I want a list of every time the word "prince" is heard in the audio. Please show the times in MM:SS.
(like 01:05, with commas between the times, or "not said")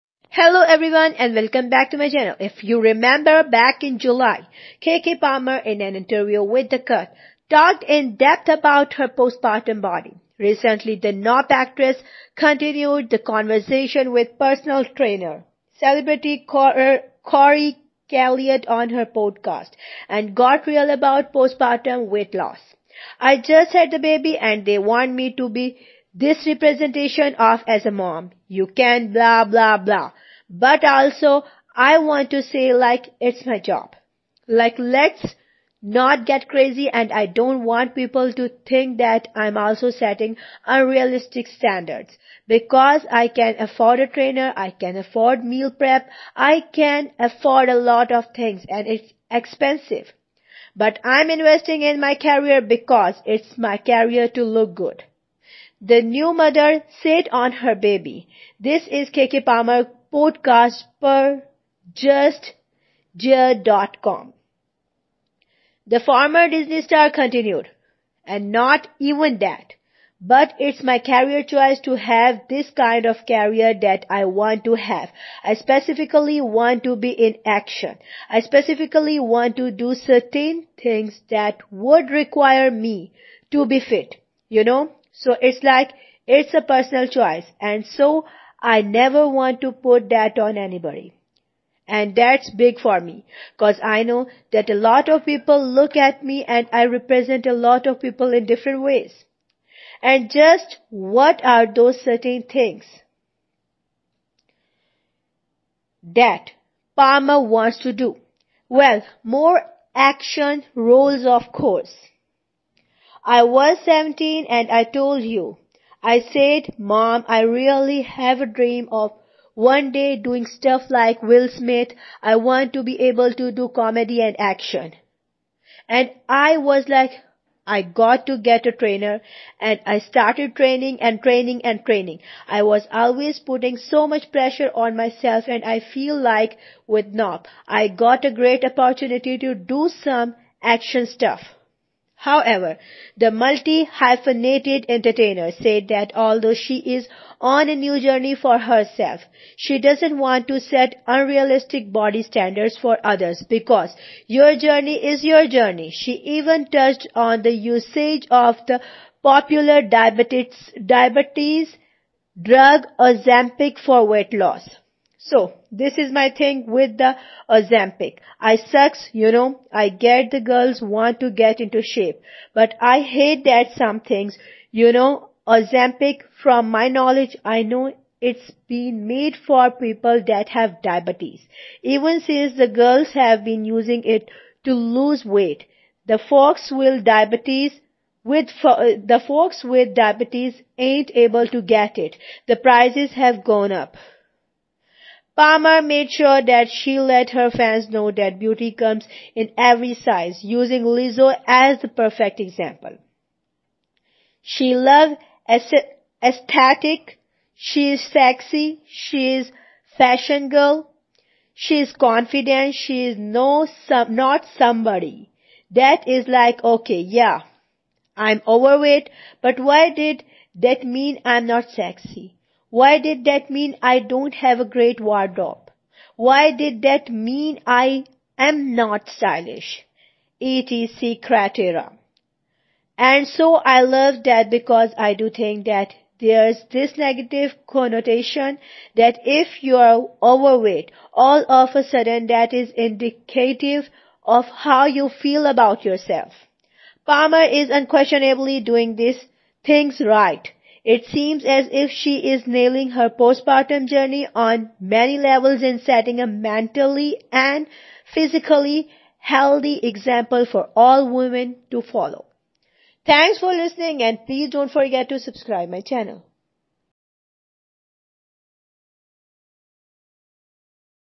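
not said.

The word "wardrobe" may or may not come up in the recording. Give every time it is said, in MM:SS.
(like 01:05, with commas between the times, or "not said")
03:45.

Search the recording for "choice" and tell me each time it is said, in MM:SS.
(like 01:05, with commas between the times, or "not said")
01:11, 01:27.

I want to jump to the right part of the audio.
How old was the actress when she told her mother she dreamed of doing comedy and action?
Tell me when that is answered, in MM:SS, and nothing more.
01:53.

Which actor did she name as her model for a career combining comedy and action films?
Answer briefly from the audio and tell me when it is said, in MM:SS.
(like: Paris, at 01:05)
Will Smith, at 02:01.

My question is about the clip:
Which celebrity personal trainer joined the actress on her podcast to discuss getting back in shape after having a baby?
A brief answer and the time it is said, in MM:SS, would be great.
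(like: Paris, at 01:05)
Corey Calliet, at 00:16.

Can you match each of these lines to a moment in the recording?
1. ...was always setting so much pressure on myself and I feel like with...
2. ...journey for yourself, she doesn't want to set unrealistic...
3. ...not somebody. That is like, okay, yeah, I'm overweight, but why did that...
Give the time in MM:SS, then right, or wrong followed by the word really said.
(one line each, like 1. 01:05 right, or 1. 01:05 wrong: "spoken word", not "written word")
1. 02:12 wrong: "putting", not "setting"
2. 02:27 wrong: "herself", not "yourself"
3. 03:34 right.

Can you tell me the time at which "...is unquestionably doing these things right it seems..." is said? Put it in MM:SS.
04:07.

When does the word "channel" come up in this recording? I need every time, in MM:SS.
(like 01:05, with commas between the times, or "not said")
00:02, 04:25.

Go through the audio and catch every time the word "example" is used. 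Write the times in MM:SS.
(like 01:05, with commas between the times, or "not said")
03:22, 04:19.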